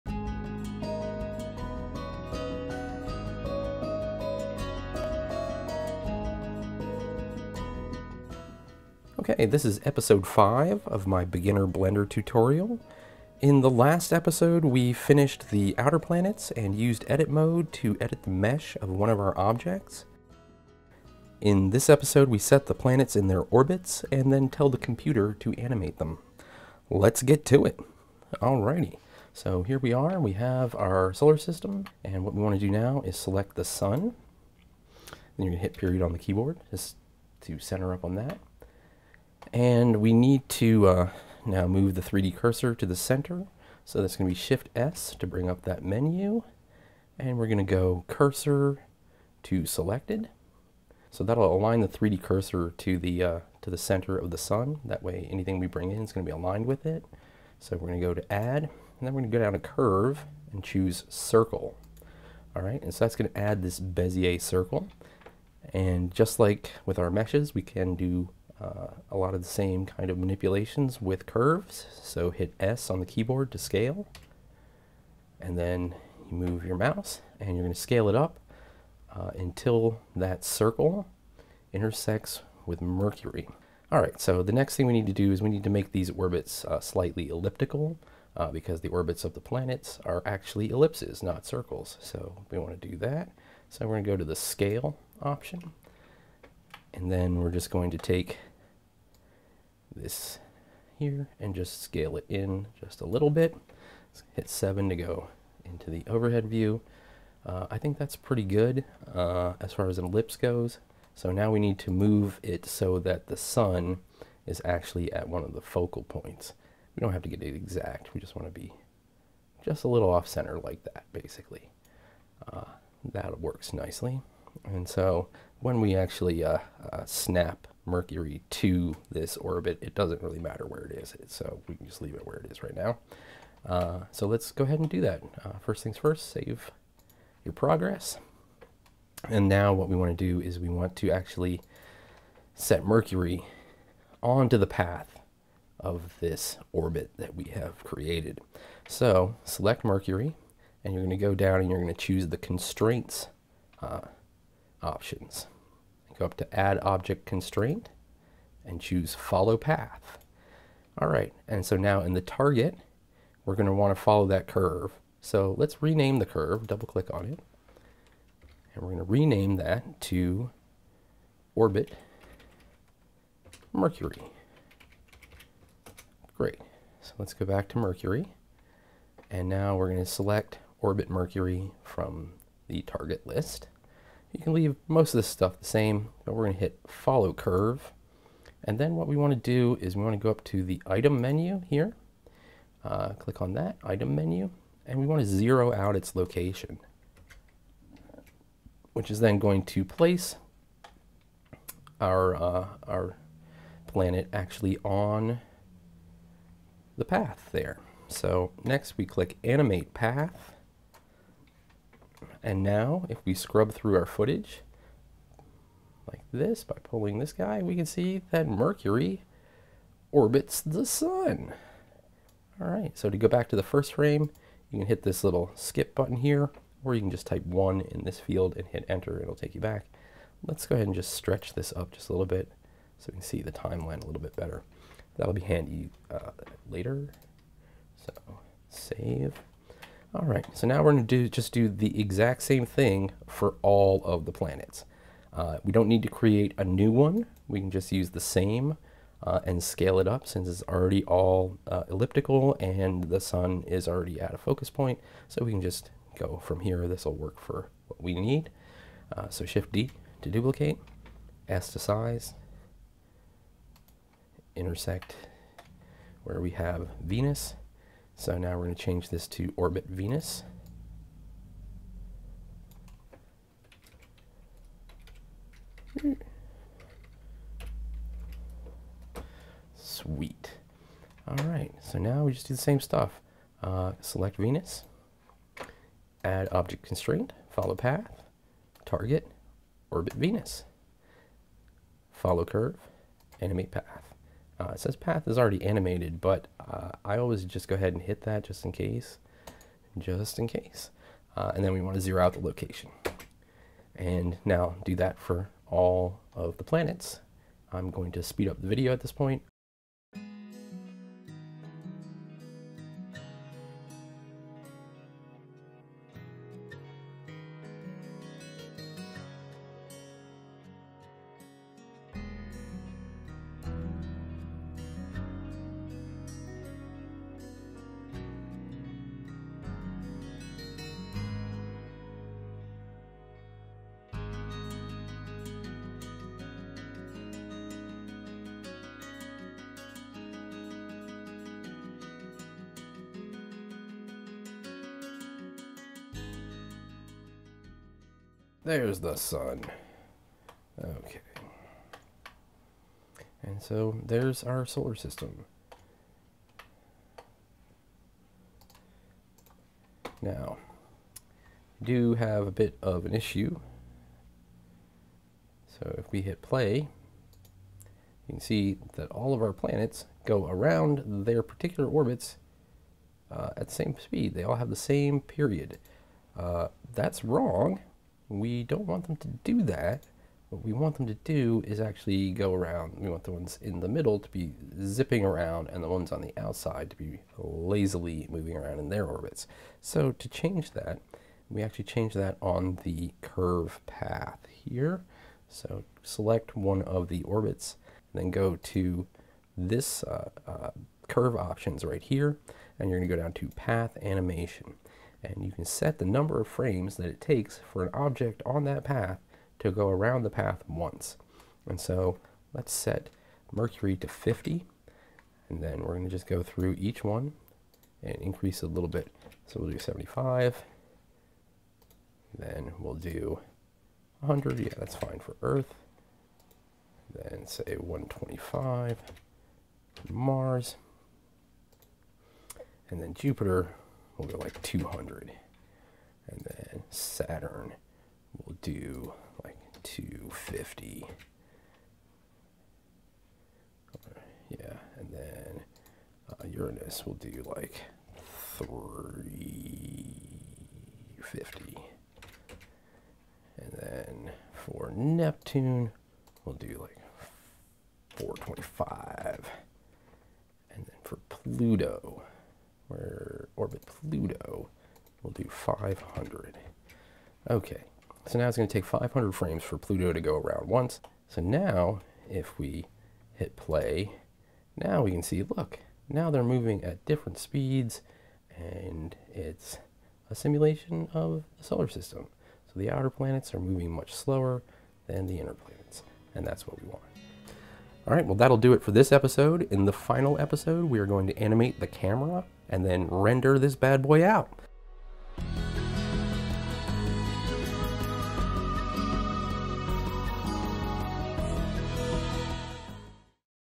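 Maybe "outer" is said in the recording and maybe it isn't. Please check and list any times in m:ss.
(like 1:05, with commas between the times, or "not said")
0:15, 8:02.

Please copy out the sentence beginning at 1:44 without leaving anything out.
Let's hit 7 to go into the overhead view.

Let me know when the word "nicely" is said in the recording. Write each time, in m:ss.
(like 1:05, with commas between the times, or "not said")
2:03.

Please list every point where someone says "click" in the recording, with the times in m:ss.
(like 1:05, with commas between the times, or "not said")
2:46, 3:13, 3:29.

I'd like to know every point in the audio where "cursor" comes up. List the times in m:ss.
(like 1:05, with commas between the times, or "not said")
0:42, 0:48, 0:52.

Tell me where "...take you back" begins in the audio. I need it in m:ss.
3:49.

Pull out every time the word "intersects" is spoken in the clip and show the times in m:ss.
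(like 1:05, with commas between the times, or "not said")
1:21, 4:24.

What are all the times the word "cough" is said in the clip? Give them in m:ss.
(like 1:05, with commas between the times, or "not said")
not said.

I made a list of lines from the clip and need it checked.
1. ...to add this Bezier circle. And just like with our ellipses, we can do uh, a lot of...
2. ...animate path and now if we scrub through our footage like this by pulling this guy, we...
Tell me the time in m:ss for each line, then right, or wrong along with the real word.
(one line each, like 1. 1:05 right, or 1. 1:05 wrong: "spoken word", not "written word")
1. 1:03 wrong: "meshes", not "ellipses"
2. 3:29 right.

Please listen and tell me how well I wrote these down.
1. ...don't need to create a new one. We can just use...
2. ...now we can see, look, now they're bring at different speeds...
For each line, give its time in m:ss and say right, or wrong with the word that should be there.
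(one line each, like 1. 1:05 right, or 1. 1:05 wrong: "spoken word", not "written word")
1. 4:05 right
2. 7:54 wrong: "moving", not "bring".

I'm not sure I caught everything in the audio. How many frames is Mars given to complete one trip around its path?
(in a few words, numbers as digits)
125.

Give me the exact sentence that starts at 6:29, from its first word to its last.
So to change that, we actually change that on the curve path here.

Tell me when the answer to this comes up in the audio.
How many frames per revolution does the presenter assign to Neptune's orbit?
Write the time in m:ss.
7:38.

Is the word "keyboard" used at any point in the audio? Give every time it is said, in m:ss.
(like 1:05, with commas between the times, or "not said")
0:36, 1:13.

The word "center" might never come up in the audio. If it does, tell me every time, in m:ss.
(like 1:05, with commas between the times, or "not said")
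0:37, 0:42, 0:53, 2:00.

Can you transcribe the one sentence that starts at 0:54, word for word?
That way anything we bring in is going to be aligned with it.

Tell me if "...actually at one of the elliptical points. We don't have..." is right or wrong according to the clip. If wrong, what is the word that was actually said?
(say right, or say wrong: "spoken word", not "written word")
wrong: "focal", not "elliptical".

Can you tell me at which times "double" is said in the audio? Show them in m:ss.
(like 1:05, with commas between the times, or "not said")
2:46.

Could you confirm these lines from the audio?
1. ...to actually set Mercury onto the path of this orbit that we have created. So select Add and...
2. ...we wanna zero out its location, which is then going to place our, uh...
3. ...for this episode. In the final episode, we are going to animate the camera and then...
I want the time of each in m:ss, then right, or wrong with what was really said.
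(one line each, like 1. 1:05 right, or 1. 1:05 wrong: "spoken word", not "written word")
1. 2:20 wrong: "Mercury", not "Add"
2. 3:14 right
3. 8:08 right.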